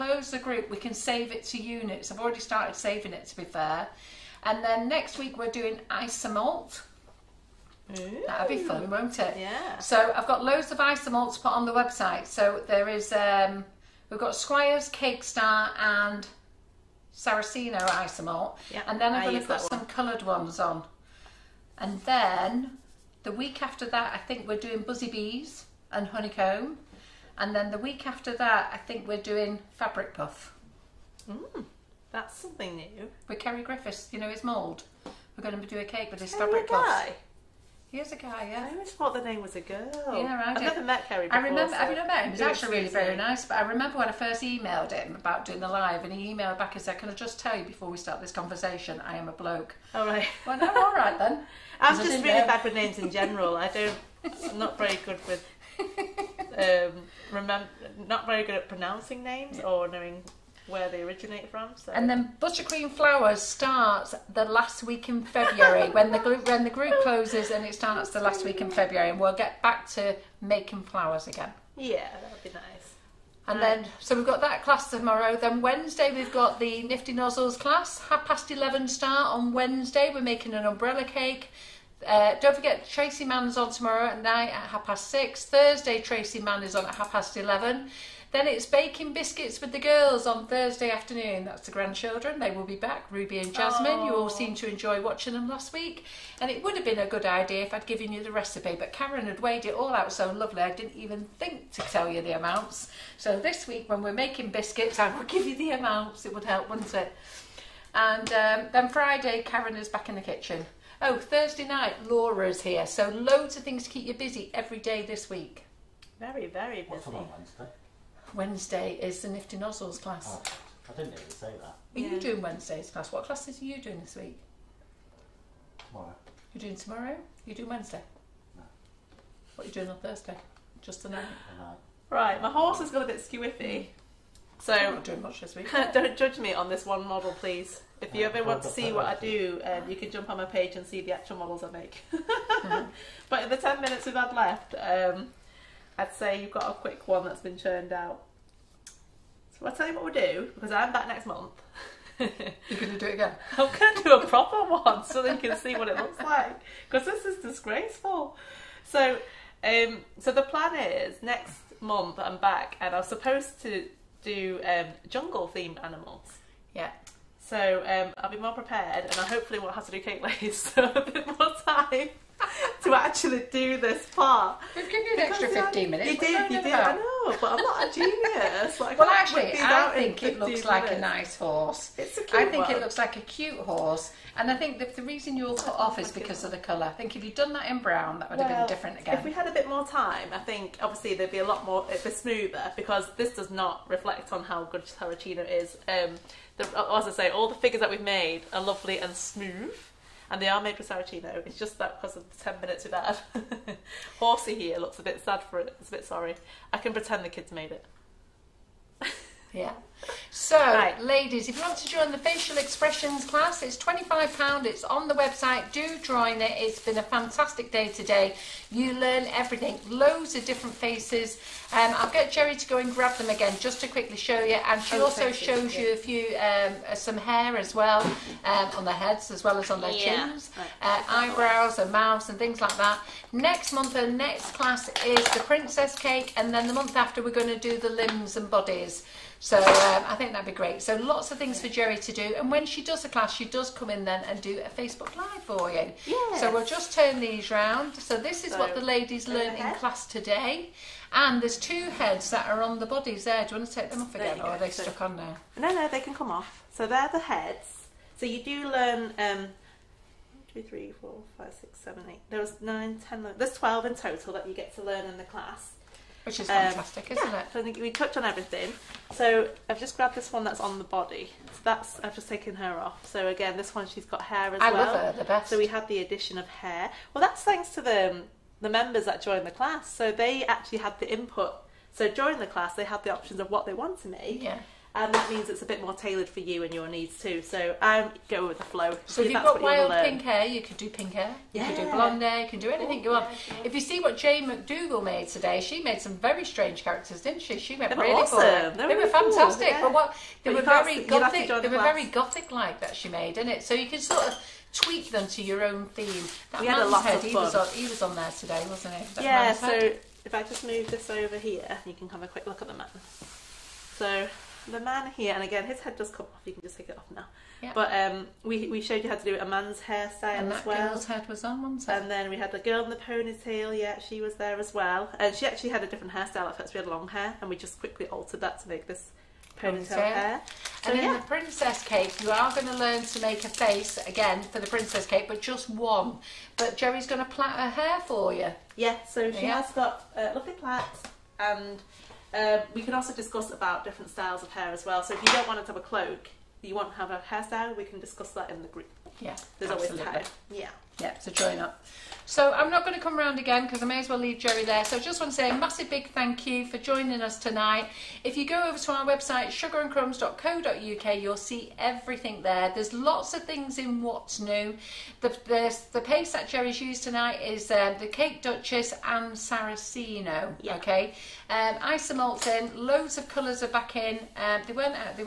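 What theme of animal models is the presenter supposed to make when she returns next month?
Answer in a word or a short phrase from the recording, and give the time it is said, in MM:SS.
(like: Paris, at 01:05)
Jungle themed animals, at 02:45.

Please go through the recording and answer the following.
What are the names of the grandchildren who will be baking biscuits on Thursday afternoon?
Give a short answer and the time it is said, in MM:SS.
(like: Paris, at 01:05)
Ruby and Jasmine, at 01:33.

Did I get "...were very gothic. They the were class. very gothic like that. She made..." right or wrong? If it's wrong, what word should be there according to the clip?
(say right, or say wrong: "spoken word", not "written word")
right.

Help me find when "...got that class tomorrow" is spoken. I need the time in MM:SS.
01:14.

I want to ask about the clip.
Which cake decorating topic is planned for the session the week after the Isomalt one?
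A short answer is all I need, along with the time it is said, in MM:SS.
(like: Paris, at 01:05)
Buzzy Bees and Honeycomb, at 00:24.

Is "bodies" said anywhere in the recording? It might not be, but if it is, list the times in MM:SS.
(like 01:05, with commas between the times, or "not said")
03:58, 04:12.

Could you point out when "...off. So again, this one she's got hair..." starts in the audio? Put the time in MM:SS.
04:32.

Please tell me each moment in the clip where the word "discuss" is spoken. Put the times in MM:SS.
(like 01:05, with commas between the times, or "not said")
05:43, 05:47.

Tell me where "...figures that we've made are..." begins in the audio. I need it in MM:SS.
03:17.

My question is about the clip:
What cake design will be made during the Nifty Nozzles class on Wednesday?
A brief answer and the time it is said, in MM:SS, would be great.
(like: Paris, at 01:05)
Umbrella cake, at 01:20.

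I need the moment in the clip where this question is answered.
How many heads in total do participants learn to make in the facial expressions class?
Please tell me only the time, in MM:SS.
04:23.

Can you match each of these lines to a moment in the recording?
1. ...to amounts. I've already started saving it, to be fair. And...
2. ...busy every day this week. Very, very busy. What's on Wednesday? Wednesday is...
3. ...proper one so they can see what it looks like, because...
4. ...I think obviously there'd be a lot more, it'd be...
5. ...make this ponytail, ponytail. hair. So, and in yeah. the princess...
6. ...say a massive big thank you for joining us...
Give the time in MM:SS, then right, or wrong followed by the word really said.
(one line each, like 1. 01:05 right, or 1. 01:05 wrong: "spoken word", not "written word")
1. 00:01 wrong: "units", not "amounts"
2. 01:54 right
3. 02:34 right
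4. 03:10 right
5. 05:28 right
6. 05:55 right.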